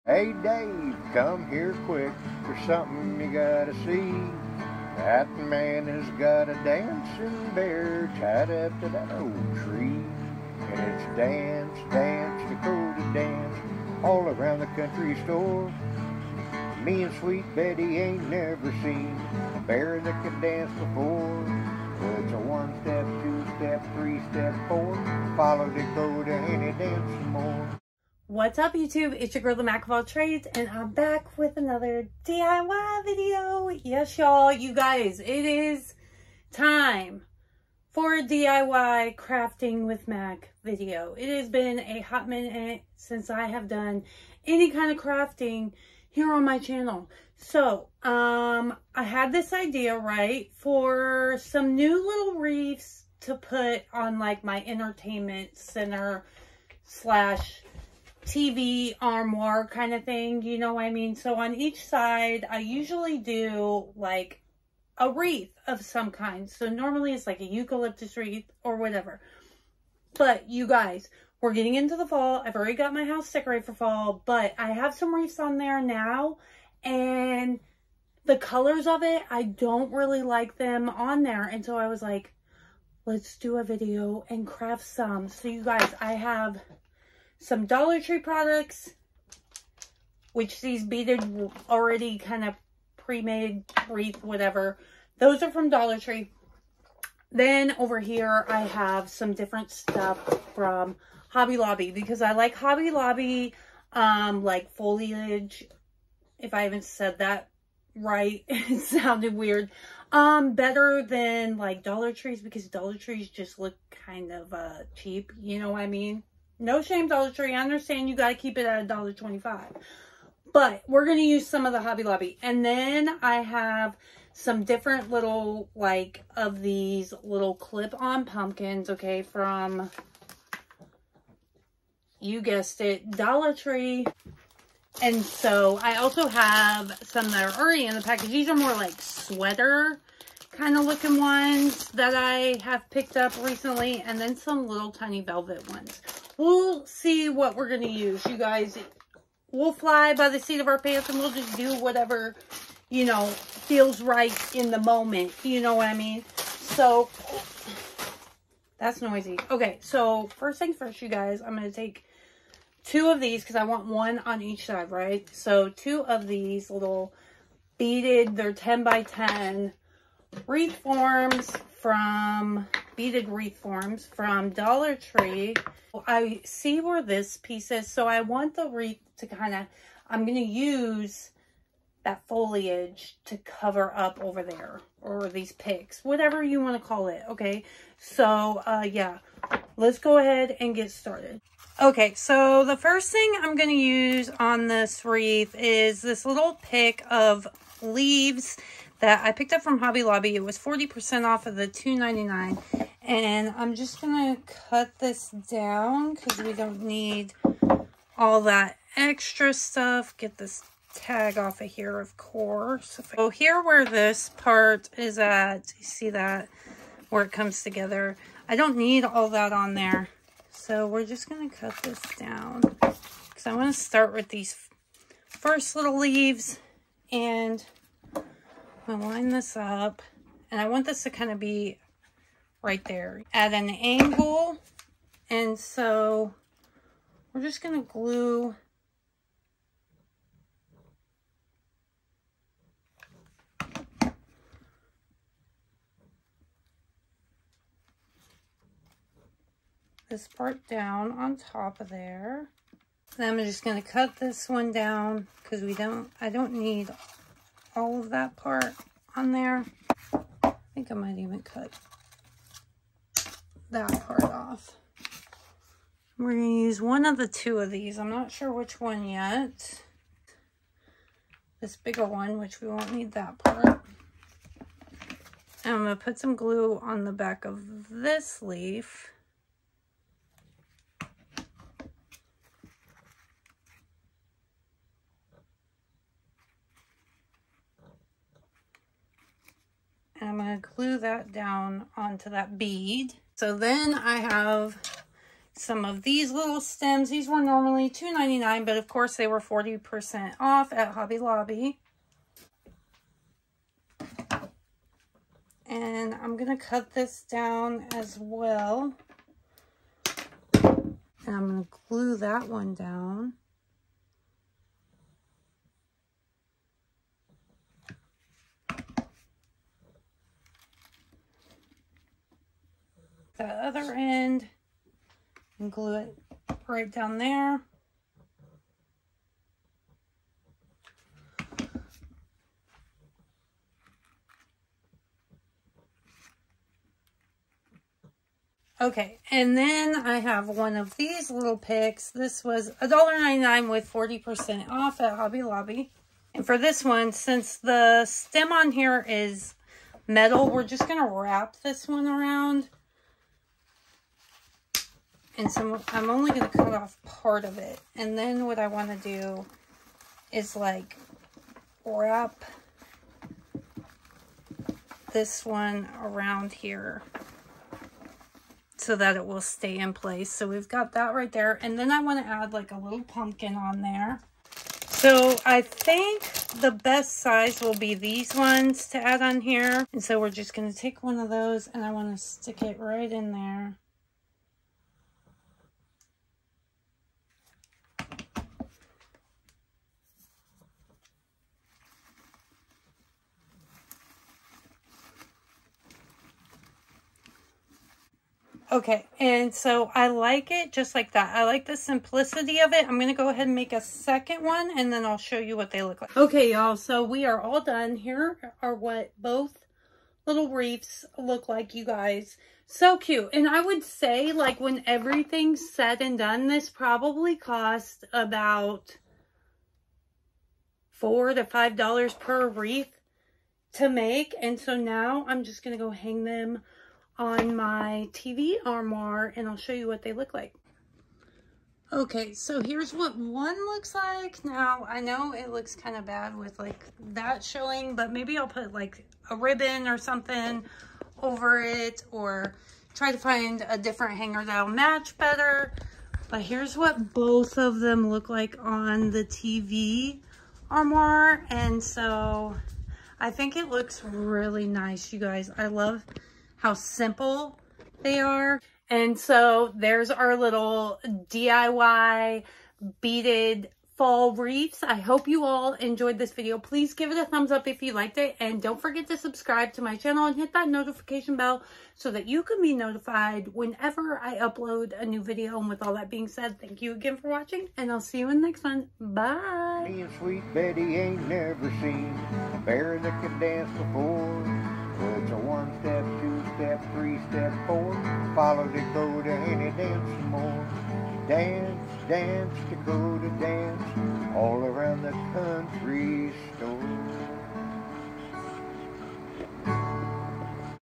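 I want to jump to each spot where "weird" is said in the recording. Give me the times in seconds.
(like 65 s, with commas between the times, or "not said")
109 s.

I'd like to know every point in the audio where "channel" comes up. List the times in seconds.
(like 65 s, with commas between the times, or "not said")
46 s, 469 s.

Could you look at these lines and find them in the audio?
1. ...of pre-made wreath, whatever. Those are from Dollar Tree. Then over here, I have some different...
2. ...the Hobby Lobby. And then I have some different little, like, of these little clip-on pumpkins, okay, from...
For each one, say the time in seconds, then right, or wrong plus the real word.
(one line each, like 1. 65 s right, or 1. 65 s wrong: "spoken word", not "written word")
1. 92 s right
2. 121 s right.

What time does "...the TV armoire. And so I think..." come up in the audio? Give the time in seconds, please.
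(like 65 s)
449 s.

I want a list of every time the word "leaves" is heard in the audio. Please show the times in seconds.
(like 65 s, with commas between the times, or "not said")
197 s, 225 s.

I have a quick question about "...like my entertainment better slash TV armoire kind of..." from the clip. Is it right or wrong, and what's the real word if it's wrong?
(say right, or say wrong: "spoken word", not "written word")
wrong: "center", not "better".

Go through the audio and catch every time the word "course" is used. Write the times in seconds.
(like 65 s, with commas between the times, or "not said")
212 s, 298 s.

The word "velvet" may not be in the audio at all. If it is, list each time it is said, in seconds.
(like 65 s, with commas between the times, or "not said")
145 s.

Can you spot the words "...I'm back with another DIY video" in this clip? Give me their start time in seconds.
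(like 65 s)
30 s.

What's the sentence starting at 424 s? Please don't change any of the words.
And so now I'm just going to go hang them on my TV armoire and I'll show you what they look like.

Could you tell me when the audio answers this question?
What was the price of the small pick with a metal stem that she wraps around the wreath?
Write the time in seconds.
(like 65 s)
342 s.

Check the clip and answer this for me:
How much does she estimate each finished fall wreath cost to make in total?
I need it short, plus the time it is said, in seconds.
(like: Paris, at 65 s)
4 to $5, at 420 s.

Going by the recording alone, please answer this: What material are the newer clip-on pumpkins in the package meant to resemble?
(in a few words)
sweater.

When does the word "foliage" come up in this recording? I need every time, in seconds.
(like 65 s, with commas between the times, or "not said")
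104 s, 182 s.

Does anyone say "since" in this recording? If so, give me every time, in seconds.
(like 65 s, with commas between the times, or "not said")
42 s, 347 s.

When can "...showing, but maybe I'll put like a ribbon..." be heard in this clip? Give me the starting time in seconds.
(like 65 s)
437 s.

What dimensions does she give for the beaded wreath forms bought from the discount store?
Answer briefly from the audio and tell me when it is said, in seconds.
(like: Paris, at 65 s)
10 by 10, at 168 s.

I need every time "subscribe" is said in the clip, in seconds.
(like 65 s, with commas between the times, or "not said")
469 s.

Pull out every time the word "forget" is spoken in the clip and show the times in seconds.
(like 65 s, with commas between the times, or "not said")
468 s.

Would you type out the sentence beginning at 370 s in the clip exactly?
So we've got that right there.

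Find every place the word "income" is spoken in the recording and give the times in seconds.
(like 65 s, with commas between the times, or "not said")
not said.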